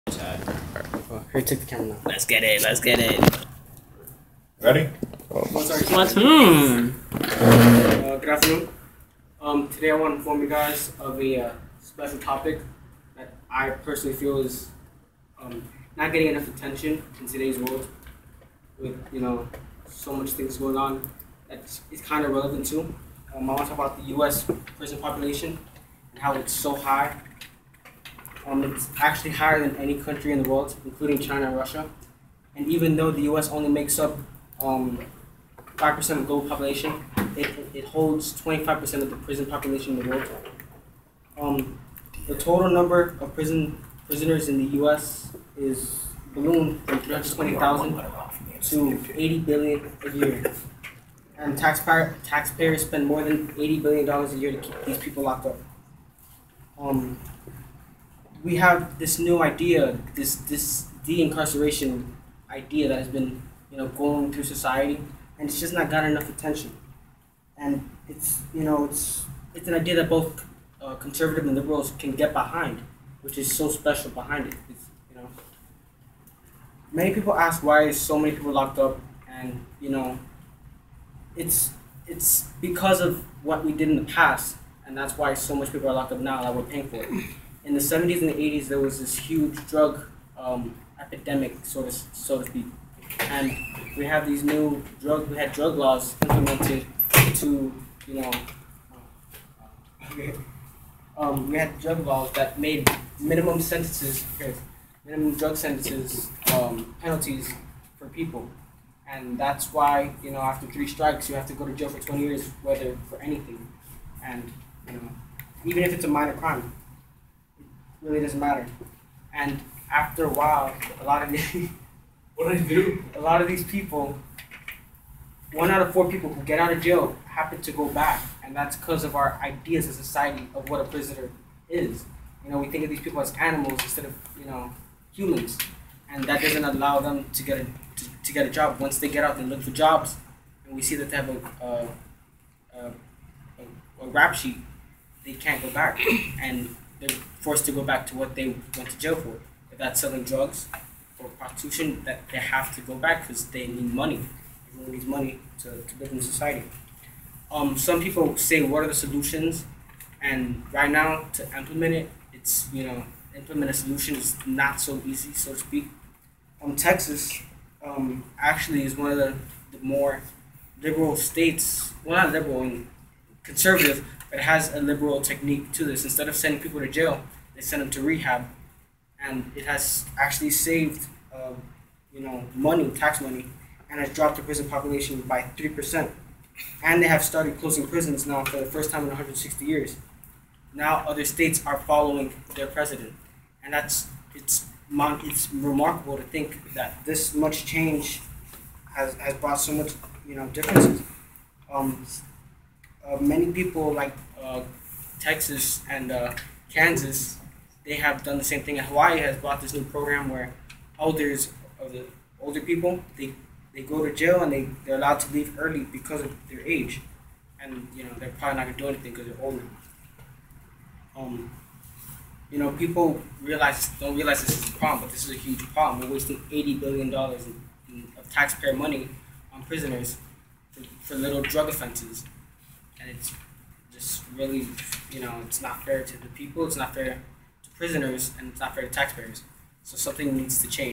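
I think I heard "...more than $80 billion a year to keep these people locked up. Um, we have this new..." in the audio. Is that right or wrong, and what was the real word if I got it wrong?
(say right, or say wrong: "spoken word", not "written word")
right.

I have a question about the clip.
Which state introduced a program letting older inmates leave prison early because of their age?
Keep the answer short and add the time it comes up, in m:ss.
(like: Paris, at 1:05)
Hawaii, at 3:28.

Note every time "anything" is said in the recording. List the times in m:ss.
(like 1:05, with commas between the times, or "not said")
1:53, 3:38.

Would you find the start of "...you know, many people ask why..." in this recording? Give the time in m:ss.
1:15.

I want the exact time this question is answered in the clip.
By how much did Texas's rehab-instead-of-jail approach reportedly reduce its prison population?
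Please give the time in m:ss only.
3:05.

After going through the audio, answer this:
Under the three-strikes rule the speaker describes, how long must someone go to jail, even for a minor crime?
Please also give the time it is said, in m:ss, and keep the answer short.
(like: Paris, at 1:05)
20 years, at 1:51.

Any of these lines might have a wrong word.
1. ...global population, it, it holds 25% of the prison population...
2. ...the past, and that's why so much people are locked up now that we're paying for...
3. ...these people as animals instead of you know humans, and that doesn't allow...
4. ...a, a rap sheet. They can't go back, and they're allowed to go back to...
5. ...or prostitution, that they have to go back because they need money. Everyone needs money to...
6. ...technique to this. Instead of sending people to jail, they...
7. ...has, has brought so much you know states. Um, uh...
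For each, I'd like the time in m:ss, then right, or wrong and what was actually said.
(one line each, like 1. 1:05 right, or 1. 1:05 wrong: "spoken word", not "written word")
1. 0:36 right
2. 1:23 right
3. 2:12 right
4. 2:22 wrong: "forced", not "allowed"
5. 2:31 right
6. 2:55 right
7. 3:18 wrong: "differences", not "states".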